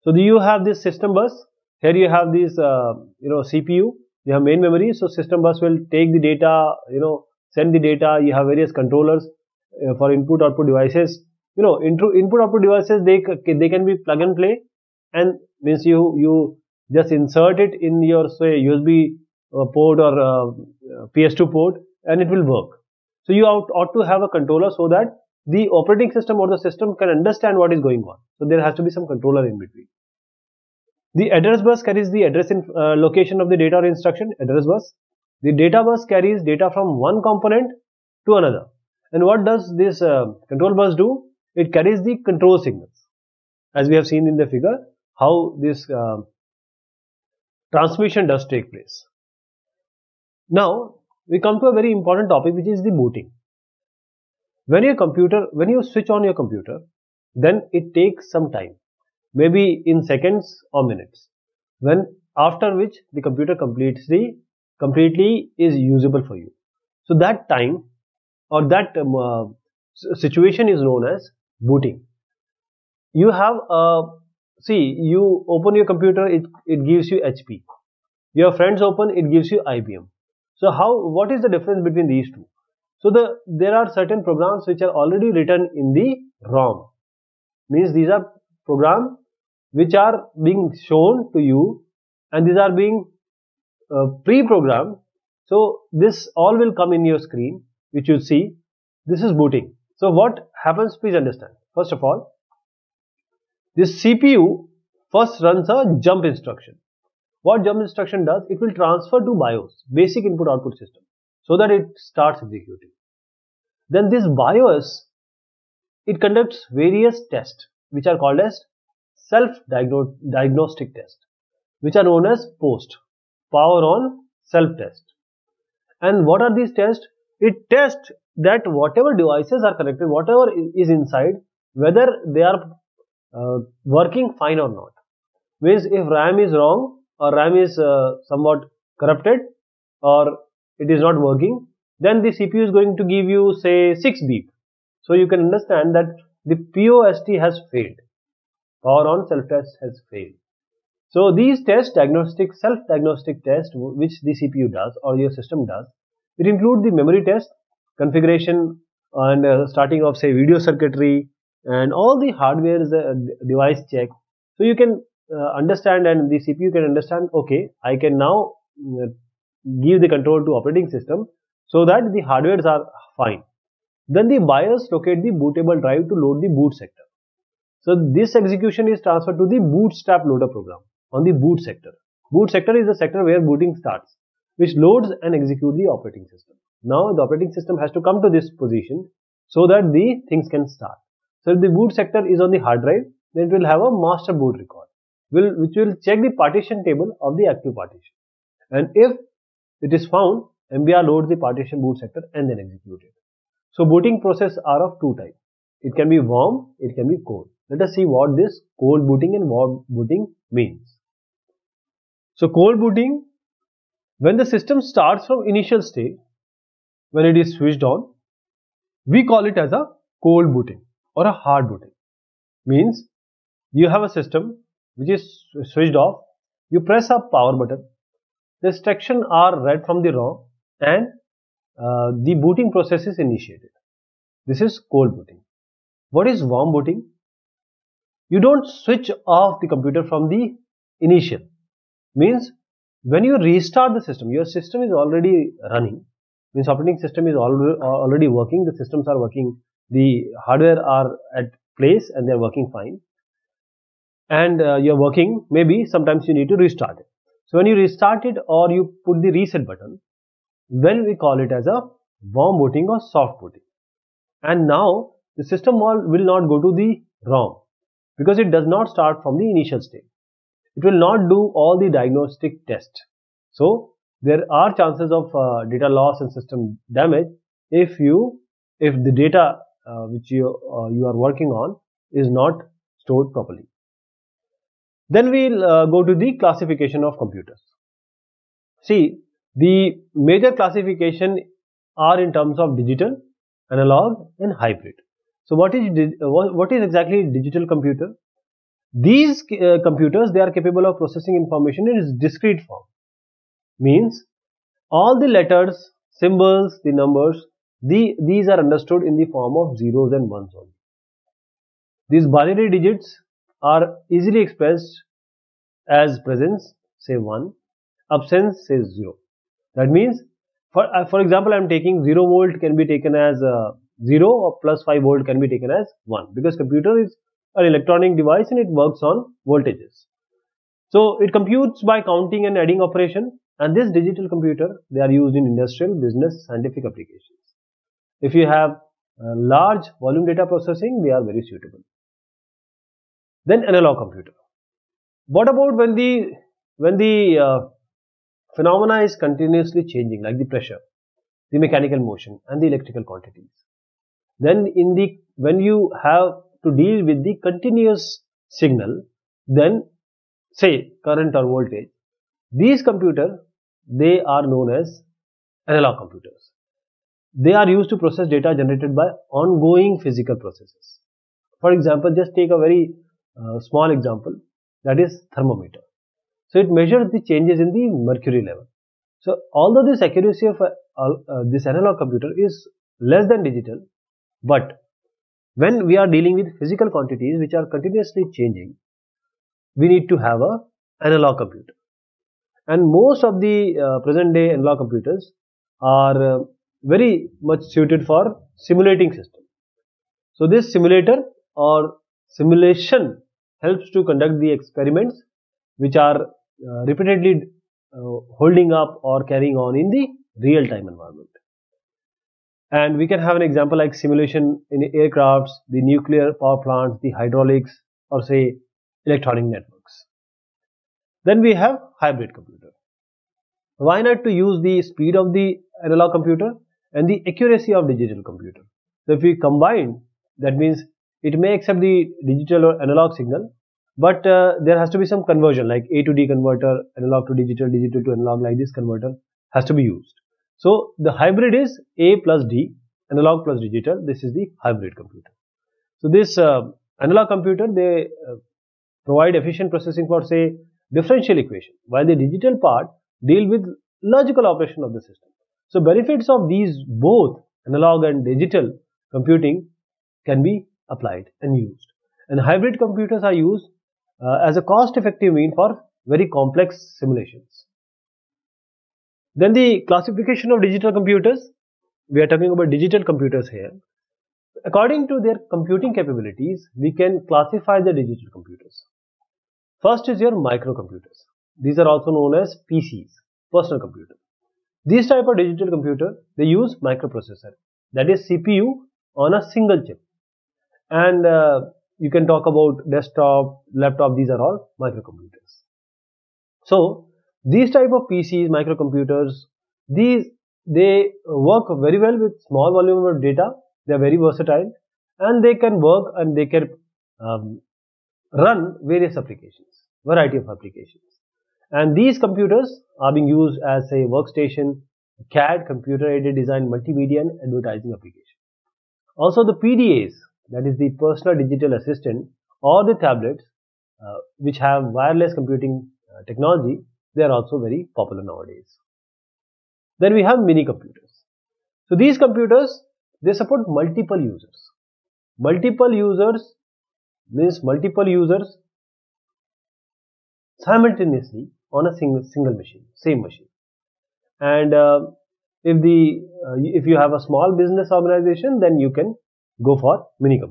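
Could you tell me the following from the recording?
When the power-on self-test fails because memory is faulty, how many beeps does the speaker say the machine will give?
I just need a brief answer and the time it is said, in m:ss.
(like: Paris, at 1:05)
6, at 2:23.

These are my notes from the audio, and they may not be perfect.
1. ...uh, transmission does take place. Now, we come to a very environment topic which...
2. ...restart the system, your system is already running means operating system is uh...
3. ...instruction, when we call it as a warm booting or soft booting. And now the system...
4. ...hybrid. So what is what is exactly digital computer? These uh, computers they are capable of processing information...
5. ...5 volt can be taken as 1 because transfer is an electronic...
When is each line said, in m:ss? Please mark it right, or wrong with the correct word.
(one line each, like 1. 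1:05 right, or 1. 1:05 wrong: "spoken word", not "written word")
1. 0:45 wrong: "important", not "environment"
2. 4:03 right
3. 4:19 wrong: "button", not "instruction"
4. 4:54 right
5. 5:24 wrong: "computer", not "transfer".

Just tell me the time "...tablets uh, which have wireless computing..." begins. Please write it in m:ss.
8:42.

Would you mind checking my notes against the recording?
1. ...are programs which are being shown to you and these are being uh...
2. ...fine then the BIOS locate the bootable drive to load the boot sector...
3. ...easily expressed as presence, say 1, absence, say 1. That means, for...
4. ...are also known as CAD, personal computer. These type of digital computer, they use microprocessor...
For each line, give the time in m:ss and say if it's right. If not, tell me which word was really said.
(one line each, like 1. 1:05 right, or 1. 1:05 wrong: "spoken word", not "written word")
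1. 1:28 right
2. 2:53 right
3. 5:14 wrong: "0", not "1"
4. 8:01 wrong: "PCs", not "CAD".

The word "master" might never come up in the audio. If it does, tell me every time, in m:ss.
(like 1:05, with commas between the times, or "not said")
3:13.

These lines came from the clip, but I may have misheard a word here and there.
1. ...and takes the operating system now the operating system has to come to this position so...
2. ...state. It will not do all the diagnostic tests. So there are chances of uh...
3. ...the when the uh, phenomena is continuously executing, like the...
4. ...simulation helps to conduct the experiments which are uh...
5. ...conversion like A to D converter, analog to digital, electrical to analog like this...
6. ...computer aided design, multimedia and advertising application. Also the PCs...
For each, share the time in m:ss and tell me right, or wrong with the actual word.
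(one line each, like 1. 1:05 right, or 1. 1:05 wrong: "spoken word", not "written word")
1. 3:05 wrong: "executes", not "takes"
2. 4:29 right
3. 5:45 wrong: "changing", not "executing"
4. 6:42 right
5. 7:15 wrong: "digital", not "electrical"
6. 8:35 wrong: "PDAs", not "PCs".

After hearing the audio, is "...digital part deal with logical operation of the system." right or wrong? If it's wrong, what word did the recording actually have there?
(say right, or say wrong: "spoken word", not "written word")
right.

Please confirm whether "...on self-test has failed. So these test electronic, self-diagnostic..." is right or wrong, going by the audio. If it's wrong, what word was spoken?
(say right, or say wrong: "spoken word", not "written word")
wrong: "diagnostic", not "electronic".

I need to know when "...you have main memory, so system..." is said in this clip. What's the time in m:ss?
0:04.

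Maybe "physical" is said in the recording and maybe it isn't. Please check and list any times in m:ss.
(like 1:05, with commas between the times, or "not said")
6:09, 6:26.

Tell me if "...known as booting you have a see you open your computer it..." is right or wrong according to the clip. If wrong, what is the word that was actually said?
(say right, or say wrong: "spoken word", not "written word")
right.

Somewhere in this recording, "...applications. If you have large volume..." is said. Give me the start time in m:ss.
5:36.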